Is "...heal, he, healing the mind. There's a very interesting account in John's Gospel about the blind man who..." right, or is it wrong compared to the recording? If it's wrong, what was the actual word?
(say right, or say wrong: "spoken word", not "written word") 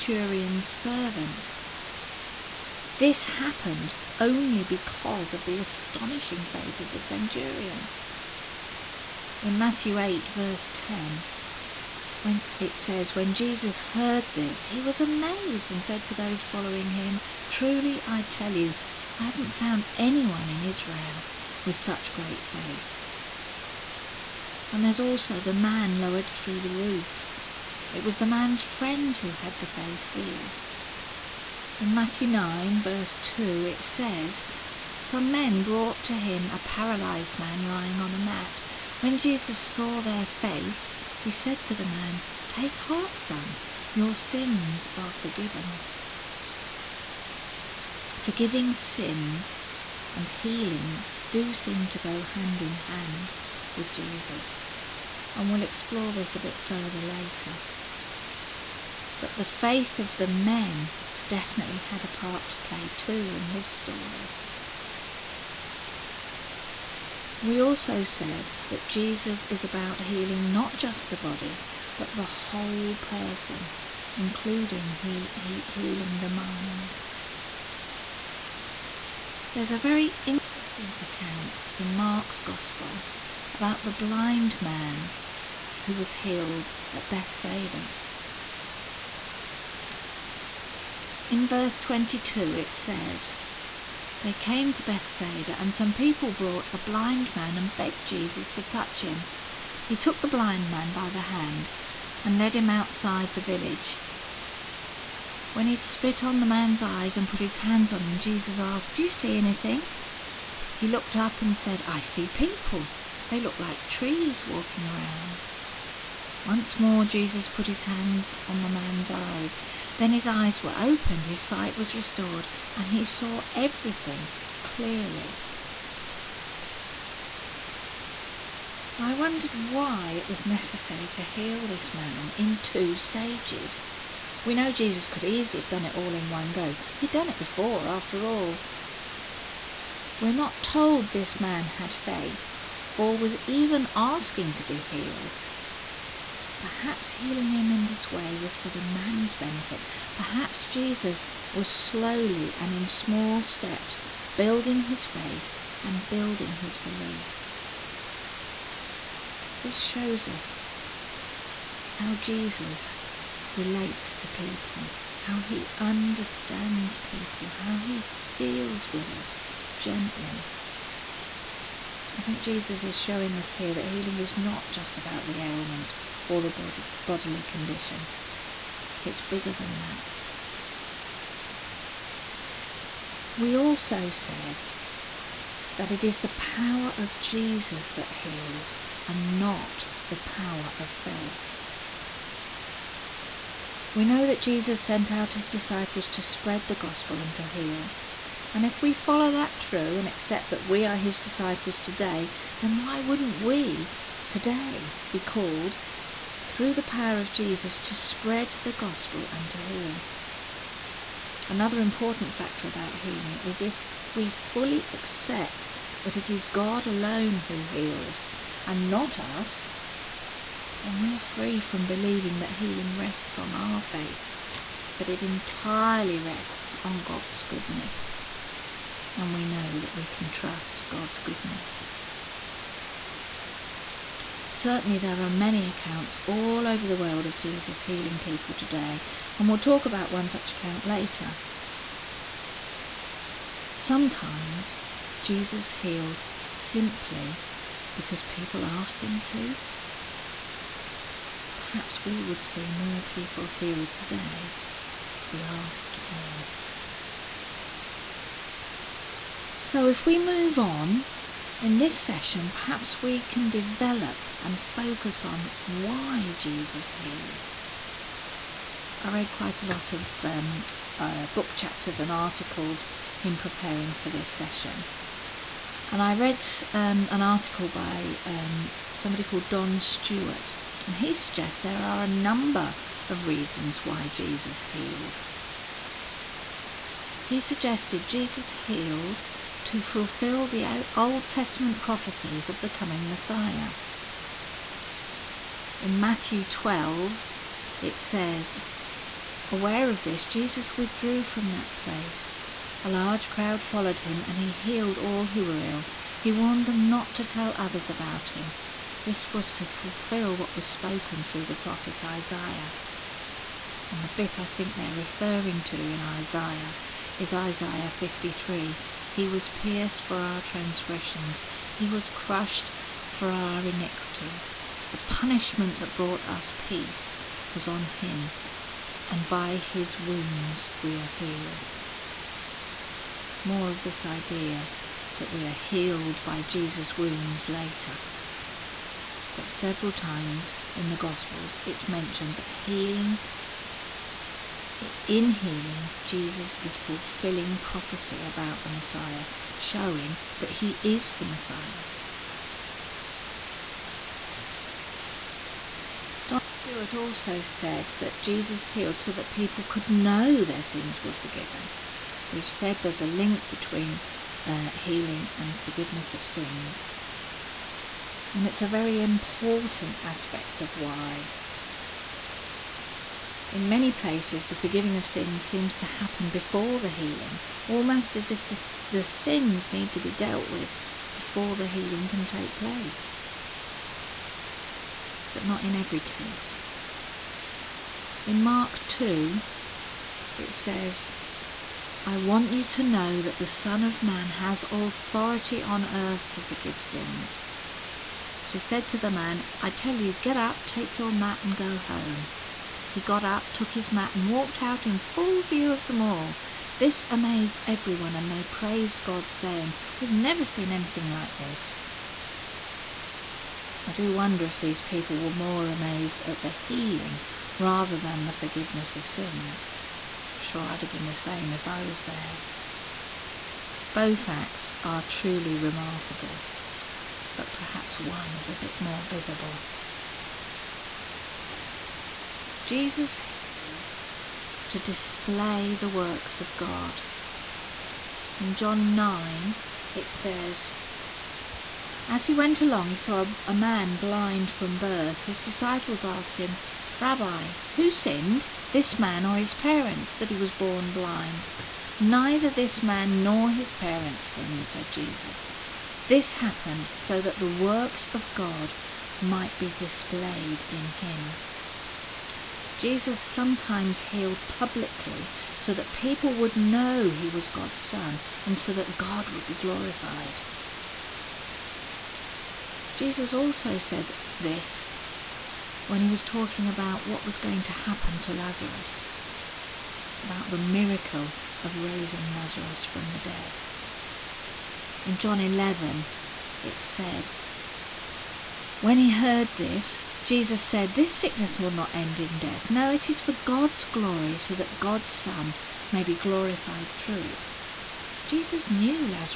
wrong: "Mark", not "John".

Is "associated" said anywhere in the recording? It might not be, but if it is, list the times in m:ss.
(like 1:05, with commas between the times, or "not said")
not said.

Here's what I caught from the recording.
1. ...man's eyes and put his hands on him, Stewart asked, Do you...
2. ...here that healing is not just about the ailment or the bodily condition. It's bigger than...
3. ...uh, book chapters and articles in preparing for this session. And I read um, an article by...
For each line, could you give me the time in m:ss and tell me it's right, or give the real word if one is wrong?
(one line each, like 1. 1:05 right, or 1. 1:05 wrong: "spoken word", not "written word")
1. 1:46 wrong: "Jesus", not "Stewart"
2. 2:53 right
3. 4:30 right.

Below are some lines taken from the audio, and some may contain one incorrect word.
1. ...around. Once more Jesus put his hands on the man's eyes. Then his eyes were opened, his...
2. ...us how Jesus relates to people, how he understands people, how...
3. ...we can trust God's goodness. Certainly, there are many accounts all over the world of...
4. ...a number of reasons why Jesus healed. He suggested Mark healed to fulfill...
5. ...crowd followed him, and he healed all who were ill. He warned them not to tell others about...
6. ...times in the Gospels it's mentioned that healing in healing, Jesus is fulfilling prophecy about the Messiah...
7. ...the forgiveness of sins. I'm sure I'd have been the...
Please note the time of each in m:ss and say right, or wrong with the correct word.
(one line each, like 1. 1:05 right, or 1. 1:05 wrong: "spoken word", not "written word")
1. 1:54 right
2. 2:40 right
3. 3:49 right
4. 4:42 wrong: "Jesus", not "Mark"
5. 5:03 right
6. 5:39 right
7. 6:58 right.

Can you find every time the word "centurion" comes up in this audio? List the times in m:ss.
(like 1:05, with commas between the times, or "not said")
0:06.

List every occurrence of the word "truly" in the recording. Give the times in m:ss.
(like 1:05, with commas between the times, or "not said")
0:17, 7:05.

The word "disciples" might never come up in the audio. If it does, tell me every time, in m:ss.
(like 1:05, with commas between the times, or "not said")
3:15, 3:21, 7:25.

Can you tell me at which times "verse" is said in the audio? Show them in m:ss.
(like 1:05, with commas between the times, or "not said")
0:10, 0:32, 1:31.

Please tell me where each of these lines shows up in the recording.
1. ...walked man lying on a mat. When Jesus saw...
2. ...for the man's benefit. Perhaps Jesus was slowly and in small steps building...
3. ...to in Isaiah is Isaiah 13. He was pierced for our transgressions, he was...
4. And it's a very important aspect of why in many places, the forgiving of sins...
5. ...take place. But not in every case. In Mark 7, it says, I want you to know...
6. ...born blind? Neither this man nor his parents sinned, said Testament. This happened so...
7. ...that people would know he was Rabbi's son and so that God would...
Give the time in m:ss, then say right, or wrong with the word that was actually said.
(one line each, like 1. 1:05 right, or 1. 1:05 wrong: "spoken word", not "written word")
1. 0:36 wrong: "paralyzed", not "walked"
2. 2:28 right
3. 5:15 wrong: "53", not "13"
4. 6:08 right
5. 6:22 wrong: "2", not "7"
6. 7:30 wrong: "Jesus", not "Testament"
7. 7:45 wrong: "God", not "Rabbi".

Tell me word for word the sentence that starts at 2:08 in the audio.
I wondered why it was necessary to heal this man in two stages.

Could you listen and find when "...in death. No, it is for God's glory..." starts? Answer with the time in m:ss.
8:12.